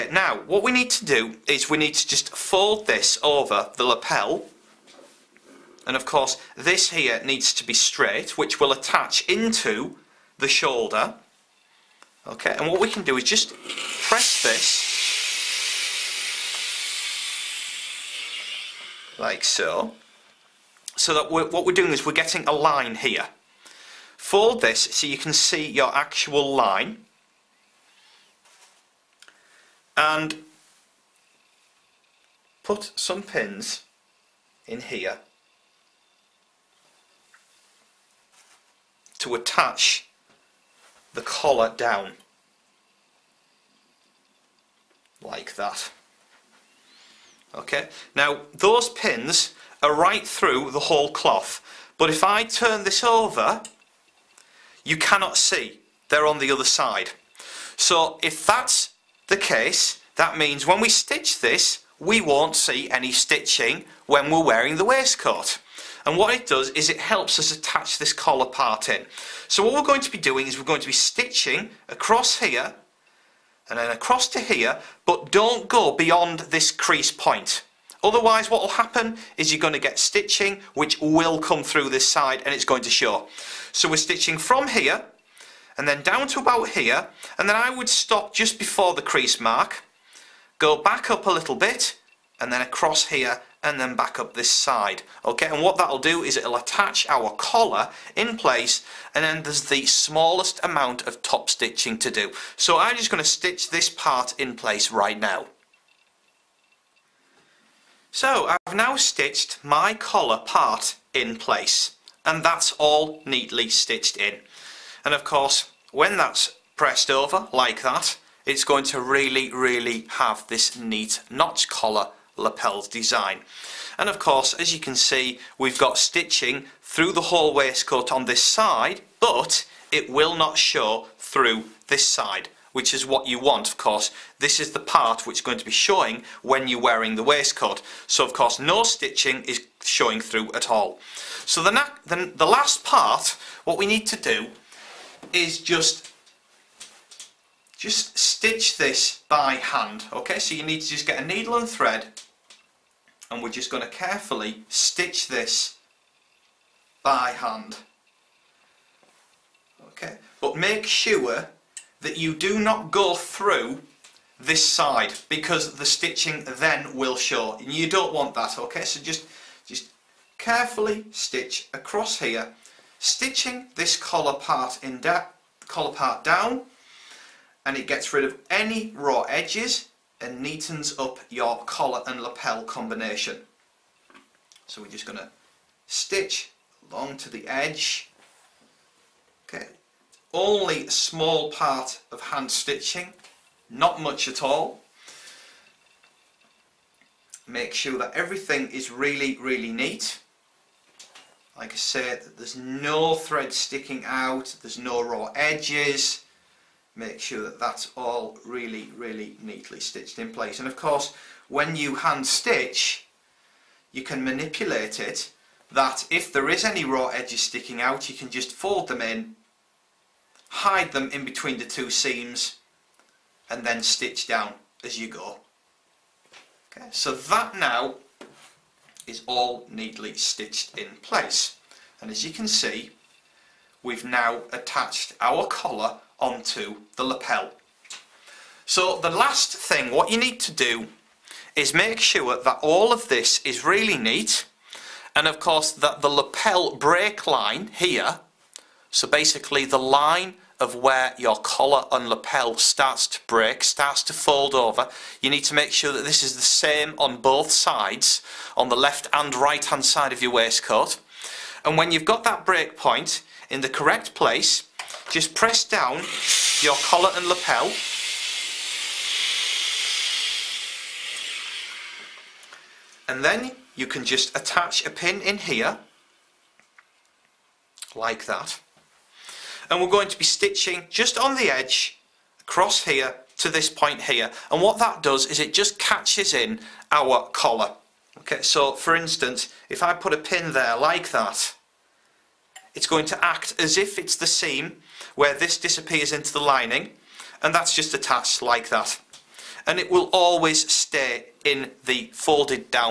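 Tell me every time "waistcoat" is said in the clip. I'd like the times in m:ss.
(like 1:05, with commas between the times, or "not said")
1:04, 2:07, 2:17, 4:20.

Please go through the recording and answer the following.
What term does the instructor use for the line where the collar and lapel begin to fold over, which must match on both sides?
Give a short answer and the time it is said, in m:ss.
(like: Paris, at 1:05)
lapel break line, at 4:06.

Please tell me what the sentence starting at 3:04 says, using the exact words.
So we're just going to stitch along to the edge.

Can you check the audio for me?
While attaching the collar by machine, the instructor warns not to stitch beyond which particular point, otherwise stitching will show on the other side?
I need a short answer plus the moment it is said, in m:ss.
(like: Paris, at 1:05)
crease point, at 1:16.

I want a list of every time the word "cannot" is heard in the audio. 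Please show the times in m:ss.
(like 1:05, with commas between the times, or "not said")
0:54.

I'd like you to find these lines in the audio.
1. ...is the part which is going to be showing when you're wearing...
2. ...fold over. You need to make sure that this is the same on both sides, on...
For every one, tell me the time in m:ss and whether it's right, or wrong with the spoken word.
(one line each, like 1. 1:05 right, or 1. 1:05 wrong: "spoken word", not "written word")
1. 2:14 right
2. 4:14 right.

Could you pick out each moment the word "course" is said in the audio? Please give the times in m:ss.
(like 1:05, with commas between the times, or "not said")
0:06, 1:55, 2:04, 2:13, 2:18, 3:30, 4:05.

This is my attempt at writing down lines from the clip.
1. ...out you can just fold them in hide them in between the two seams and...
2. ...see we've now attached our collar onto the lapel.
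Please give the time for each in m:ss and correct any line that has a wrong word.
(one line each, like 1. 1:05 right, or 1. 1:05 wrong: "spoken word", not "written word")
1. 3:37 right
2. 3:52 right.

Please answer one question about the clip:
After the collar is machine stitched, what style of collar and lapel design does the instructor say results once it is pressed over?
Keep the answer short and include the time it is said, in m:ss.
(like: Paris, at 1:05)
notch collar, at 2:01.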